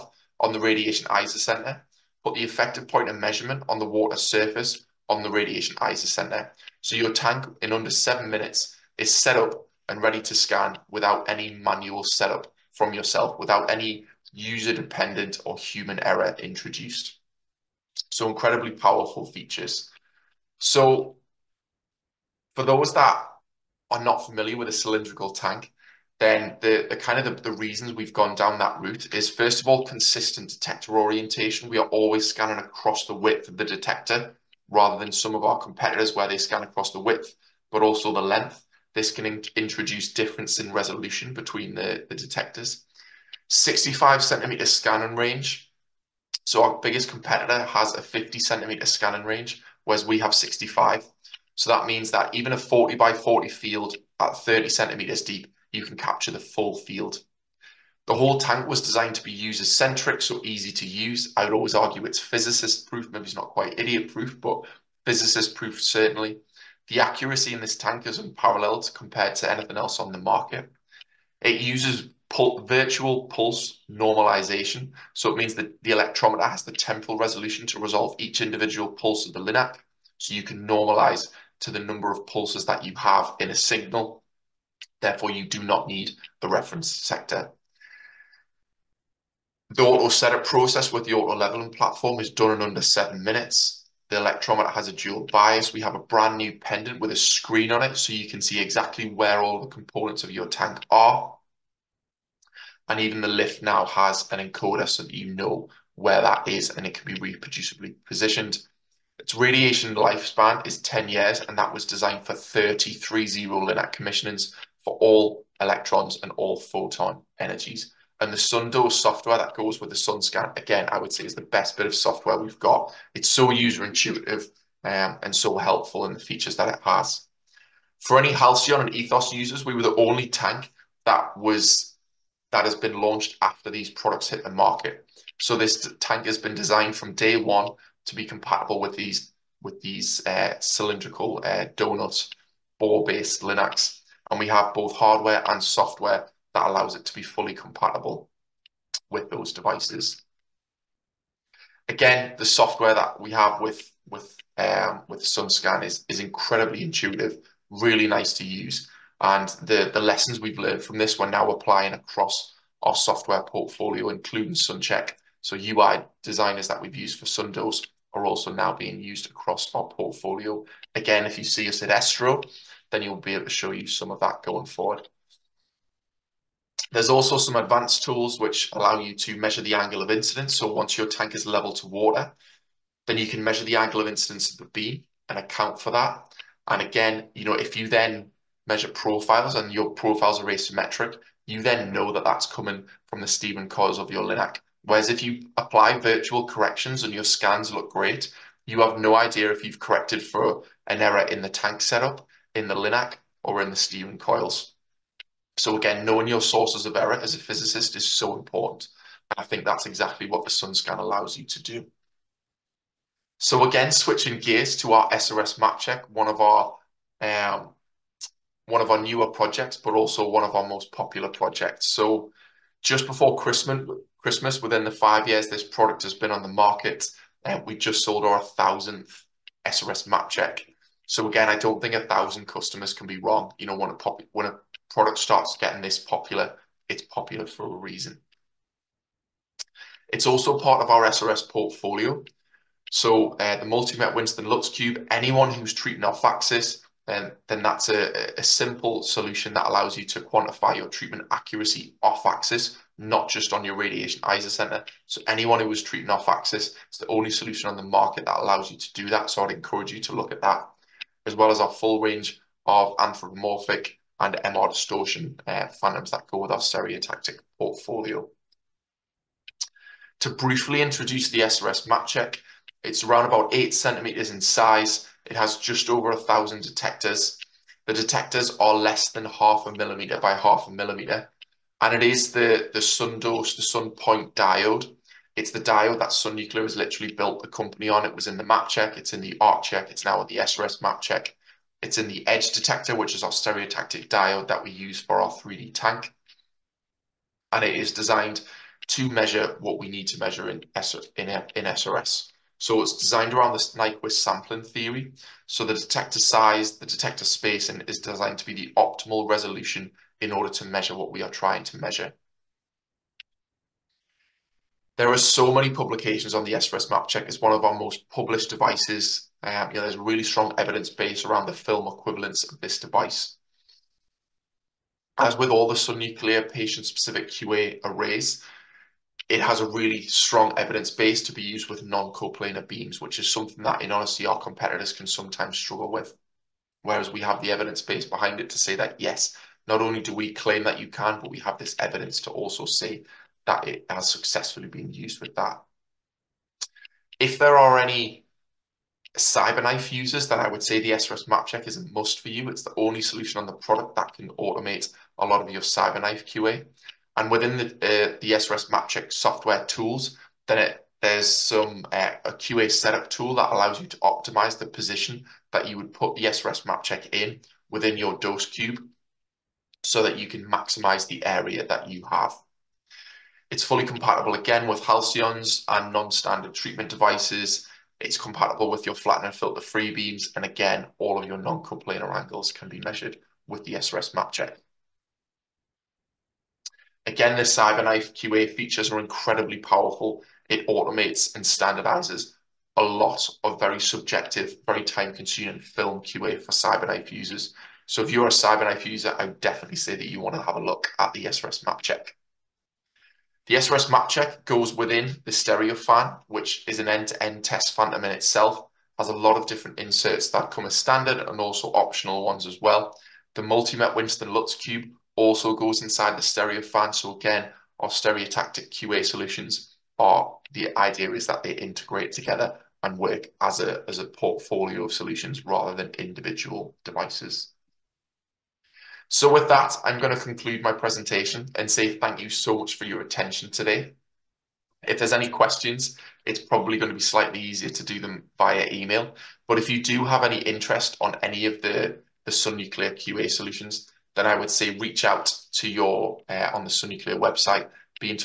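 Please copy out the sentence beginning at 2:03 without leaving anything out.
It's so user intuitive um, and so helpful in the features that it has.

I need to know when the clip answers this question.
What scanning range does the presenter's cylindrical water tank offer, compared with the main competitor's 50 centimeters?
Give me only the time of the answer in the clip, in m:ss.
0:43.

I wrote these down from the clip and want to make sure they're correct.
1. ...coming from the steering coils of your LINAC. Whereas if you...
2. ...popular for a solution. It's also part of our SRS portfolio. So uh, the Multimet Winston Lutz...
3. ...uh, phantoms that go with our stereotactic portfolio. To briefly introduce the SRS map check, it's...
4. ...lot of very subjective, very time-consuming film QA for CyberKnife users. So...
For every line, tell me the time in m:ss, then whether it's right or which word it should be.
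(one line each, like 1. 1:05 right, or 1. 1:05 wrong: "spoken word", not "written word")
1. 3:12 right
2. 3:57 wrong: "reason", not "solution"
3. 4:25 right
4. 6:32 right.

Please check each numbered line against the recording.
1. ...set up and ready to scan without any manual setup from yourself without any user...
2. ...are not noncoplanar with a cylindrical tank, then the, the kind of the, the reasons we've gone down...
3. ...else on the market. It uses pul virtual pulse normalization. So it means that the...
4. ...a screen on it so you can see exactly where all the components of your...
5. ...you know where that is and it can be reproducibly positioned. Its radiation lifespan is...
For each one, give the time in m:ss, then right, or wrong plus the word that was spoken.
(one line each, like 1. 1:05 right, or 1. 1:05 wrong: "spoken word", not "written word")
1. 0:09 right
2. 0:23 wrong: "familiar", not "noncoplanar"
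3. 1:09 right
4. 1:37 right
5. 1:45 right.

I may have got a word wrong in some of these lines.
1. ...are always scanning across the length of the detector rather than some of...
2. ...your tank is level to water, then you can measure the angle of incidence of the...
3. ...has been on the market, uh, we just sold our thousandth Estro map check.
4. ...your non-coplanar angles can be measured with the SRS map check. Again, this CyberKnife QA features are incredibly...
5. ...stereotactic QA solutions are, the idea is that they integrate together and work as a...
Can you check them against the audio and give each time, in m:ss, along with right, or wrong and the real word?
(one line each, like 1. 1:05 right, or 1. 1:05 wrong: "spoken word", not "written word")
1. 0:31 wrong: "width", not "length"
2. 3:00 right
3. 3:46 wrong: "SRS", not "Estro"
4. 6:21 right
5. 6:57 right.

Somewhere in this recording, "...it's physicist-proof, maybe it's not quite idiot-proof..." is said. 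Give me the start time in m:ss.
1:02.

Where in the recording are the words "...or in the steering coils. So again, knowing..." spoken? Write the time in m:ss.
3:23.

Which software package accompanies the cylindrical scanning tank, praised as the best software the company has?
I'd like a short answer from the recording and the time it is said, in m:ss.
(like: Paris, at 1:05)
SunDo, at 1:58.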